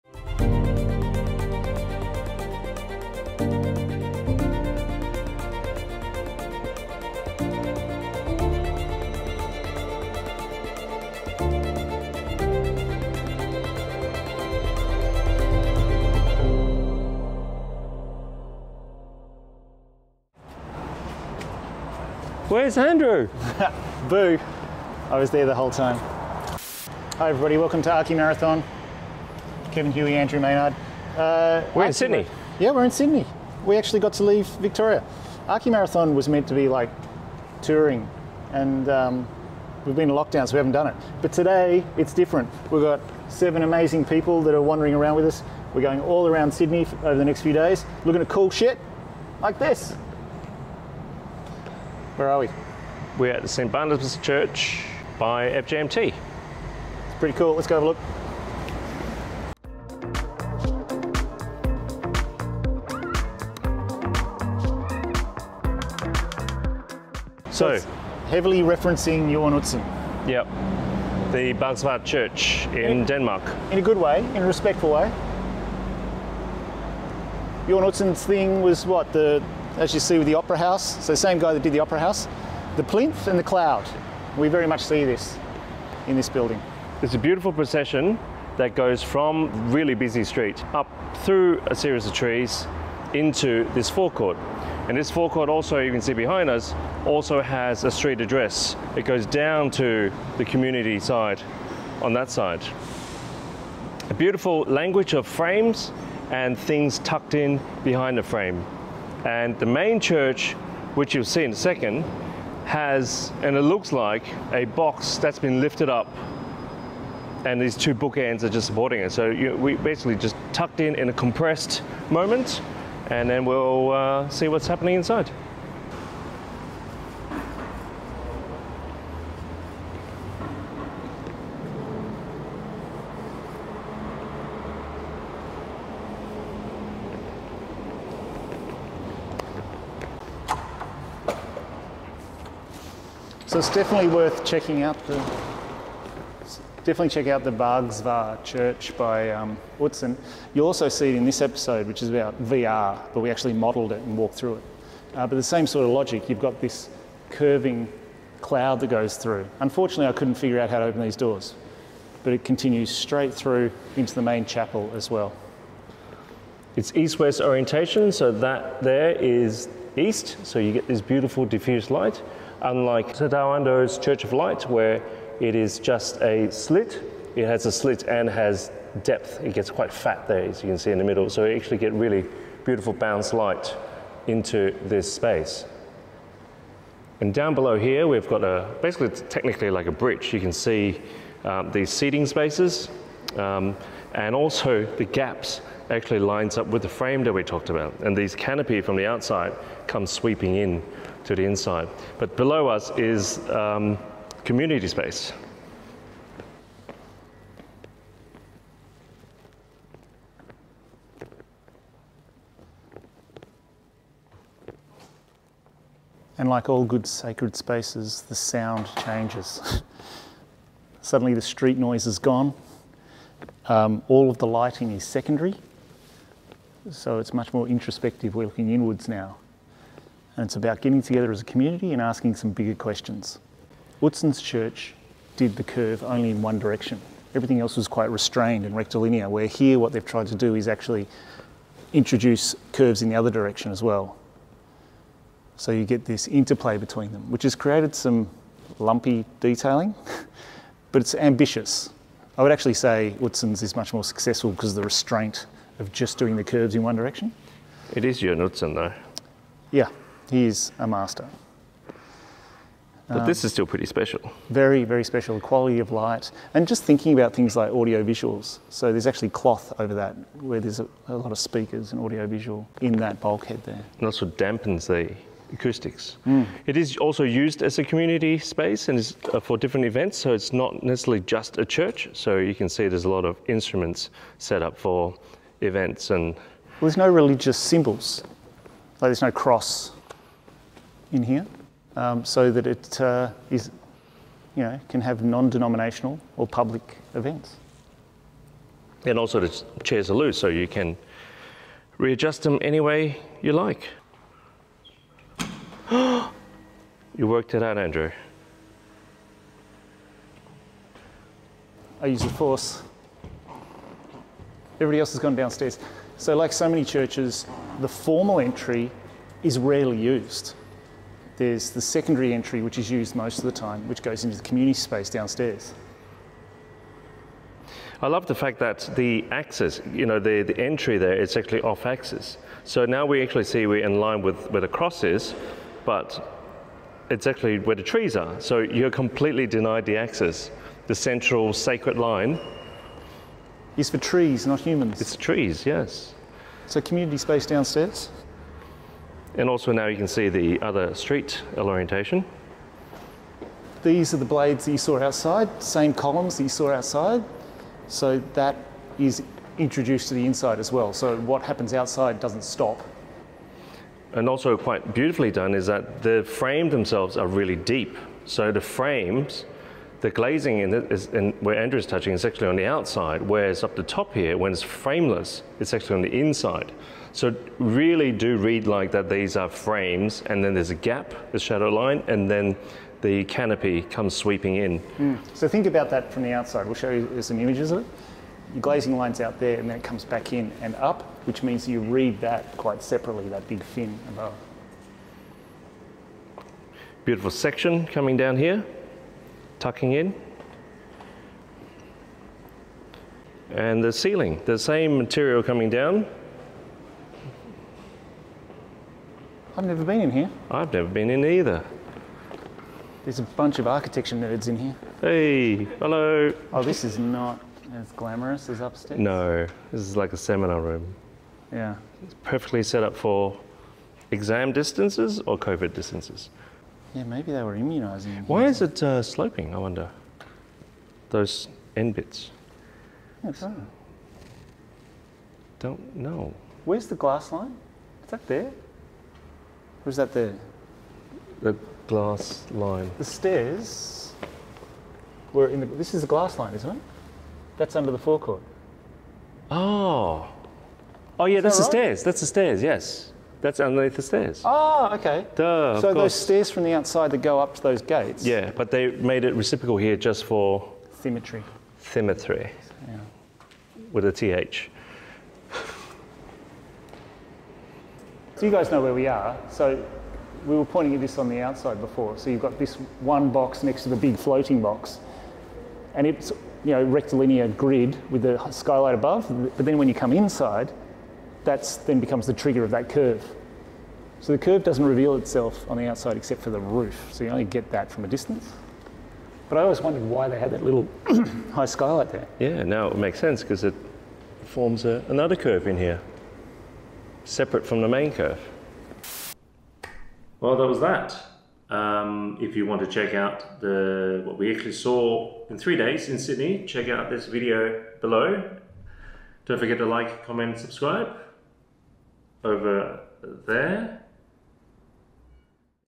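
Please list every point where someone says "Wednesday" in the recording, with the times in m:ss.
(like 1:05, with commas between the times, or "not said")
not said.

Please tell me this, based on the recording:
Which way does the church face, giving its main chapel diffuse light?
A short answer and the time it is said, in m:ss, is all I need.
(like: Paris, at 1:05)
east-west, at 2:46.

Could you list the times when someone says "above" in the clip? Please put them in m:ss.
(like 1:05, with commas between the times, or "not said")
6:34, 7:58.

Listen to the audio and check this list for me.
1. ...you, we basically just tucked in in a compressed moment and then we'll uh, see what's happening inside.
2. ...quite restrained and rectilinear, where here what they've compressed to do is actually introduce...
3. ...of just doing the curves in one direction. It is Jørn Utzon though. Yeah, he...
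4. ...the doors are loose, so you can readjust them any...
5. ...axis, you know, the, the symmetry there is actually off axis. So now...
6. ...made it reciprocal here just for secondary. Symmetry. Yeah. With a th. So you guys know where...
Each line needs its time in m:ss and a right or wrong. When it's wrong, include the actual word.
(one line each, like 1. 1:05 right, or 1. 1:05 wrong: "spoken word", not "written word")
1. 1:59 right
2. 3:57 wrong: "tried", not "compressed"
3. 4:15 right
4. 4:59 wrong: "chairs", not "doors"
5. 5:29 wrong: "entry", not "symmetry"
6. 7:38 wrong: "symmetry", not "secondary".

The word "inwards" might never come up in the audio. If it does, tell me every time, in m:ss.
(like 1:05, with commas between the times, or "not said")
3:48.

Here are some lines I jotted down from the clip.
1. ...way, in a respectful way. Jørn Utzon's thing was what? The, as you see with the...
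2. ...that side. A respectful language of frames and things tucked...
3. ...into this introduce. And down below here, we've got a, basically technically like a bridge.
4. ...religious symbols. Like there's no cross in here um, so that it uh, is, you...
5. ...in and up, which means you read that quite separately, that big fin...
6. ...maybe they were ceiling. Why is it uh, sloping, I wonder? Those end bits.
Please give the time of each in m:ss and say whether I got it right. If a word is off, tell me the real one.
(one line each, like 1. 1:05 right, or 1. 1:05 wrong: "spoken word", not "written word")
1. 1:13 right
2. 1:42 wrong: "beautiful", not "respectful"
3. 3:04 wrong: "space", not "introduce"
4. 4:47 right
5. 6:30 right
6. 7:07 wrong: "immunising", not "ceiling".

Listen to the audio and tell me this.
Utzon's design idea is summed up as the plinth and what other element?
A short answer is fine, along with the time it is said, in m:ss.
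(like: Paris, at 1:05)
the cloud, at 1:23.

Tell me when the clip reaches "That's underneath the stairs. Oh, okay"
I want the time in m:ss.
7:33.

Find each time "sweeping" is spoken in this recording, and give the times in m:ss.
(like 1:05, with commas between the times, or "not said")
3:20, 6:24.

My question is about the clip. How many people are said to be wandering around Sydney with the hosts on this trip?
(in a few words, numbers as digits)
7.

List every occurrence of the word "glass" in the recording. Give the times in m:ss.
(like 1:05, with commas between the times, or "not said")
7:16, 7:21, 7:26.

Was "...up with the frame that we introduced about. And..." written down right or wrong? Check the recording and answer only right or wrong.
wrong.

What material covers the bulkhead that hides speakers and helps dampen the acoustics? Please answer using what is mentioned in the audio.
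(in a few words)
cloth.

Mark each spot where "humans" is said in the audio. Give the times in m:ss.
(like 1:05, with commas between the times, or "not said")
5:44.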